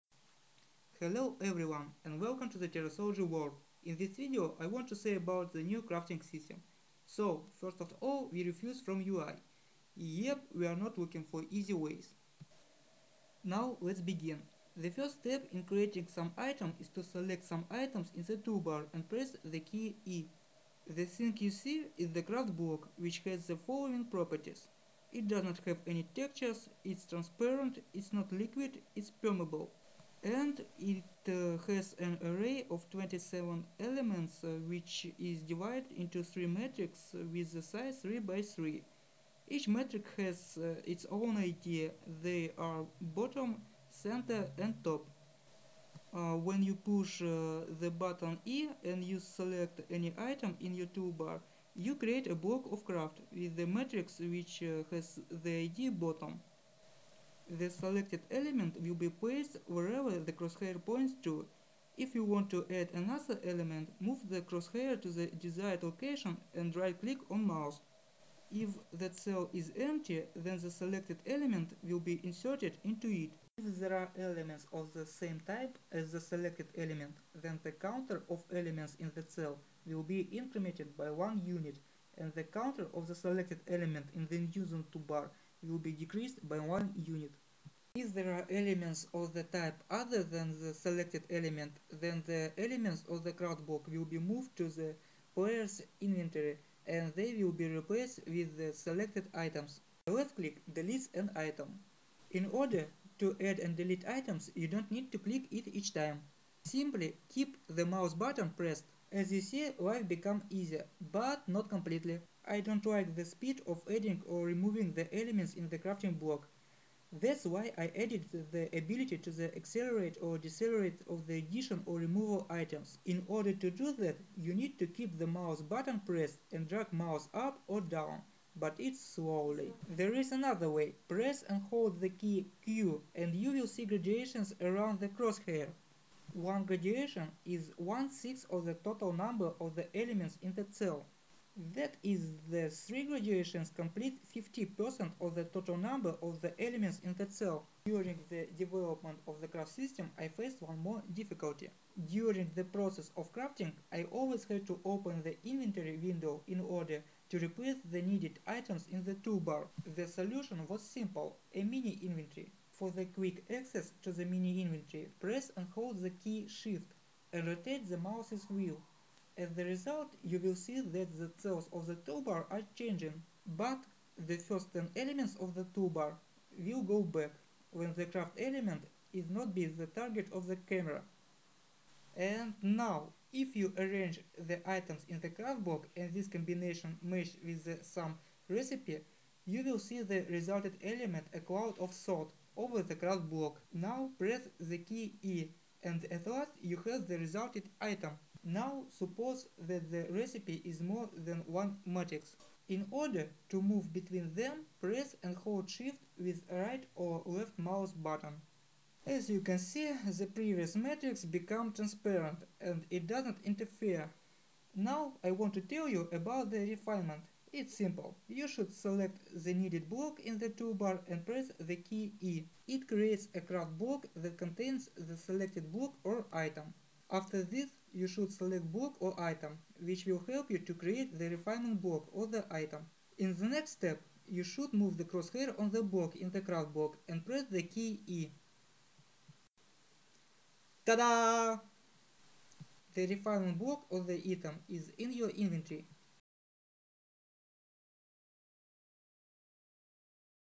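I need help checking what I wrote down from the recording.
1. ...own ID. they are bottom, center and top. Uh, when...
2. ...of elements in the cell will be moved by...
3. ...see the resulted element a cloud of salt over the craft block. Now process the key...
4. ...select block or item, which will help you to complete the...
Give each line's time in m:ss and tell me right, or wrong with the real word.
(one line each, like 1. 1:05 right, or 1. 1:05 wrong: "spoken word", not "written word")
1. 0:41 right
2. 1:18 wrong: "incremented", not "moved"
3. 3:09 wrong: "press", not "process"
4. 3:48 wrong: "create", not "complete".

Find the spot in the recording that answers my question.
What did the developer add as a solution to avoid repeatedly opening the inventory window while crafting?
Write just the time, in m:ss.
2:41.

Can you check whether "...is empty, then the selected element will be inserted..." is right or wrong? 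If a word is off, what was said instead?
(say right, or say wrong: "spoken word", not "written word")
right.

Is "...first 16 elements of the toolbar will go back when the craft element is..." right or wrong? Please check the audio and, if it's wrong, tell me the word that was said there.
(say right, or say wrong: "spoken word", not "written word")
wrong: "10", not "16".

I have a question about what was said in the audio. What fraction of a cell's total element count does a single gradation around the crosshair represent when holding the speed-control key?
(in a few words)
one-sixth.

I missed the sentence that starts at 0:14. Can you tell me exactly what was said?
The first step in creating some item is to select some items in the toolbar and press the key E.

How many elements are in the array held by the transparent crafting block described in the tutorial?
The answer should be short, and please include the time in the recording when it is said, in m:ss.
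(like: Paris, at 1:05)
27, at 0:32.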